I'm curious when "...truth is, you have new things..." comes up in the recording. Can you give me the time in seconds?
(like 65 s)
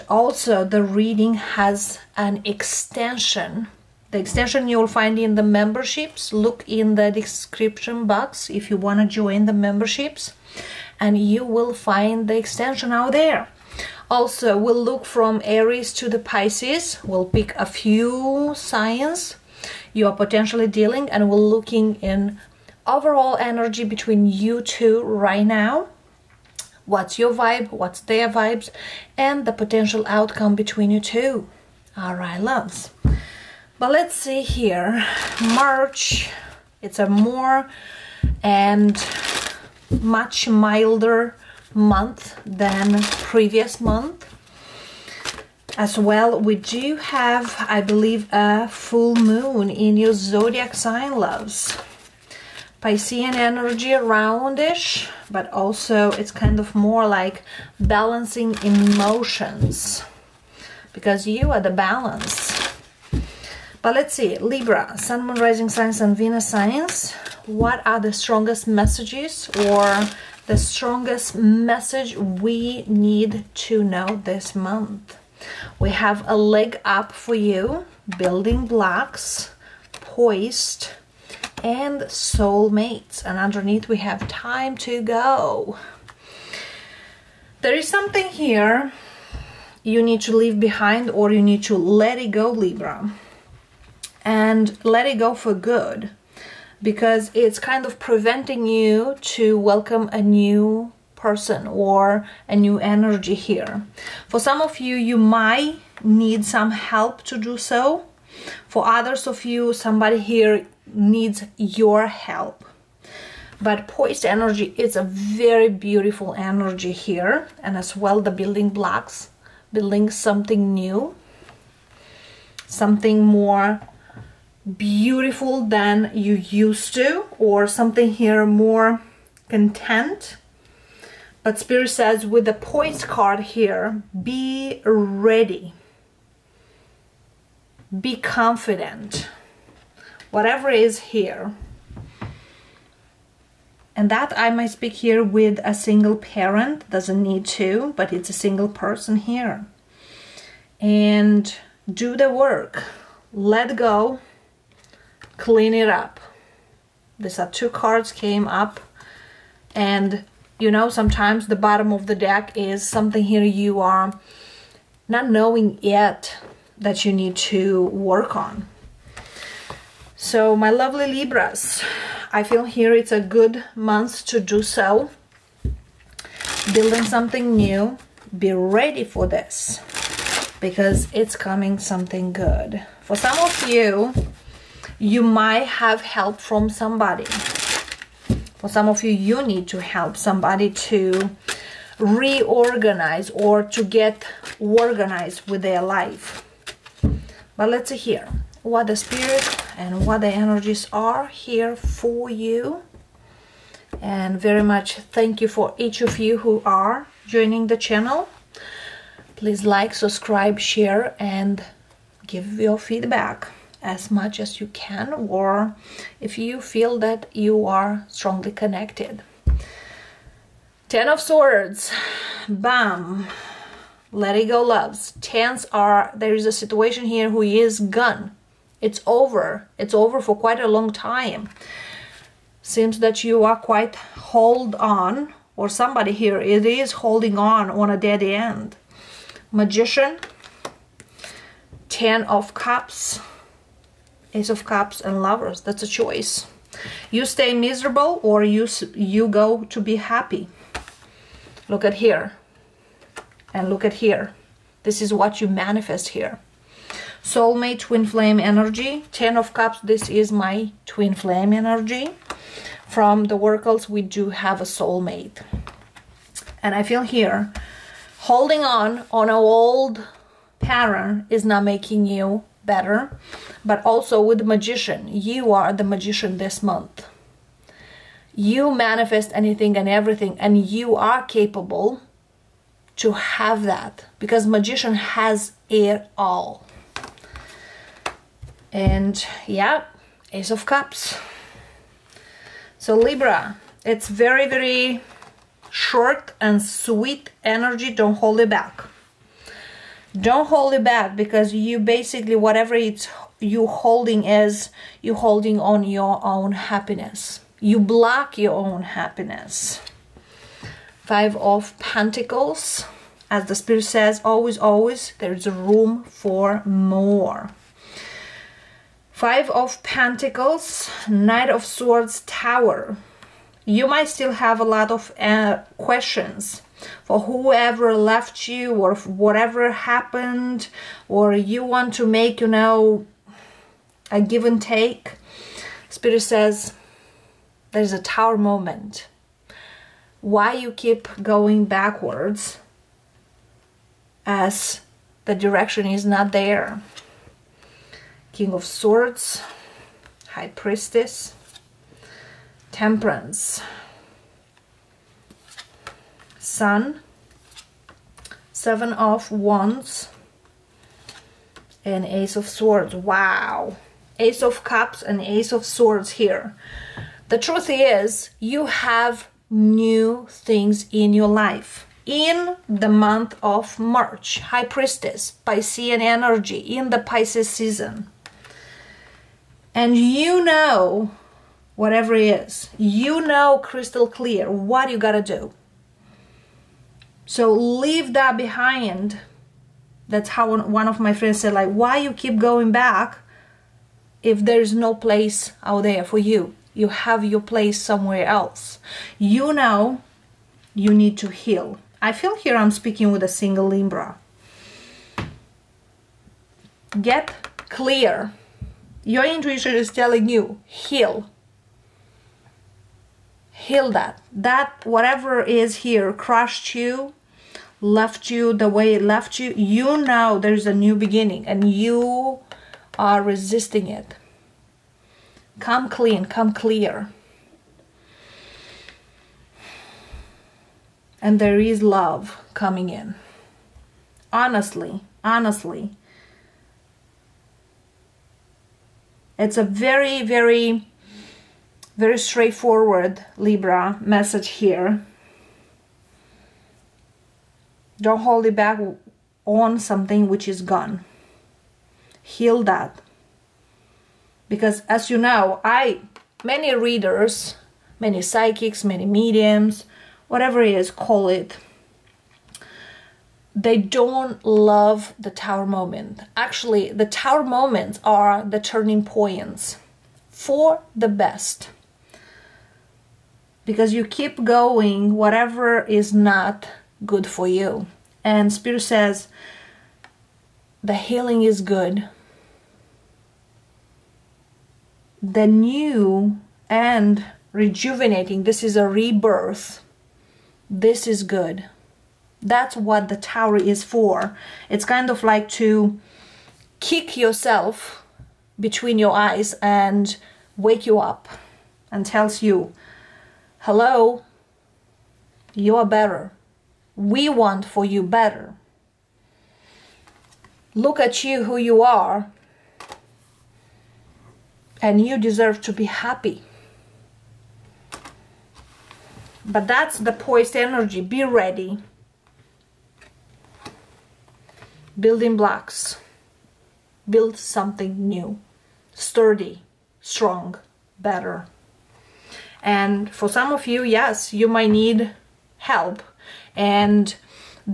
367 s.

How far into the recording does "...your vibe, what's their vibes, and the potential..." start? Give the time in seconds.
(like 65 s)
27 s.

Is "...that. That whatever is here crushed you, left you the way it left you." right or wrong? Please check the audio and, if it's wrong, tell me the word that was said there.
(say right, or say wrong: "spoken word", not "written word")
right.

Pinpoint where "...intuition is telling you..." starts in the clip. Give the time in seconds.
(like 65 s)
409 s.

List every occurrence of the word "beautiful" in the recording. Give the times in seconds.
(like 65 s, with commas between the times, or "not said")
115 s, 124 s.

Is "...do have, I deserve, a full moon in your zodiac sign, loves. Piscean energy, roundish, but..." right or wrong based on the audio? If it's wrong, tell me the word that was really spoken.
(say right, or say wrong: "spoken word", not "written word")
wrong: "believe", not "deserve".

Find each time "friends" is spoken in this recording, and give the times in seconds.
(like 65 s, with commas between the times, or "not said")
391 s.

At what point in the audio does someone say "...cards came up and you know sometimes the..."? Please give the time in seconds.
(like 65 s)
157 s.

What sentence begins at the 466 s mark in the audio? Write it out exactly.
Actually, the tower moments are the turning points for the best.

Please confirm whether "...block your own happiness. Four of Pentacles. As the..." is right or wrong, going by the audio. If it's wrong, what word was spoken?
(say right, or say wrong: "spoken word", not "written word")
wrong: "Five", not "Four".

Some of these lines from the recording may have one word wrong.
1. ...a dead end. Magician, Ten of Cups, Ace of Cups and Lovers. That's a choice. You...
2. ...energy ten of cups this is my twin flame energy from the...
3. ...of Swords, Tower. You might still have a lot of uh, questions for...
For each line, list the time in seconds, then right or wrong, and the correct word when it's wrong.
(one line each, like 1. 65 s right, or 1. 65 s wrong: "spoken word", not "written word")
1. 237 s right
2. 258 s right
3. 321 s right.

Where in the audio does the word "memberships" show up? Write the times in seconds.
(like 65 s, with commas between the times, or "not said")
5 s, 9 s.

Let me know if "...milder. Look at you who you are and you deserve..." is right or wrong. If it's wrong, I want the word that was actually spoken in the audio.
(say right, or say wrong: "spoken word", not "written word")
wrong: "better", not "milder".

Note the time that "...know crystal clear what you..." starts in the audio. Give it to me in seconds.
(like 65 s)
383 s.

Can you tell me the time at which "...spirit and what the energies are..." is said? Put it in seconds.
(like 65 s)
198 s.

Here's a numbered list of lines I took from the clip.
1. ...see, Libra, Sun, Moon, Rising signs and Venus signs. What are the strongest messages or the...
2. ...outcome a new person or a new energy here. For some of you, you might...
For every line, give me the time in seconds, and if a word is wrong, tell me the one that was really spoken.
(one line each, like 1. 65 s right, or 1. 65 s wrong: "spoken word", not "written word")
1. 64 s right
2. 99 s wrong: "welcome", not "outcome".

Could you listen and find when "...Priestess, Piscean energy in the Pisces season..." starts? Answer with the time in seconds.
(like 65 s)
374 s.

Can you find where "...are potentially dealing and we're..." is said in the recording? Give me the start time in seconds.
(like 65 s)
20 s.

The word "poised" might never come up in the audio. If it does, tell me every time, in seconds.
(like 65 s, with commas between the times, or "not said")
79 s, 113 s, 132 s, 520 s.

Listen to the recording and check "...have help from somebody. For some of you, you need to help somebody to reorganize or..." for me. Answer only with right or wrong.
right.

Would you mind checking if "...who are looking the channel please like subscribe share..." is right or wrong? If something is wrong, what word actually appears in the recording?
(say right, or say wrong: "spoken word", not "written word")
wrong: "joining", not "looking".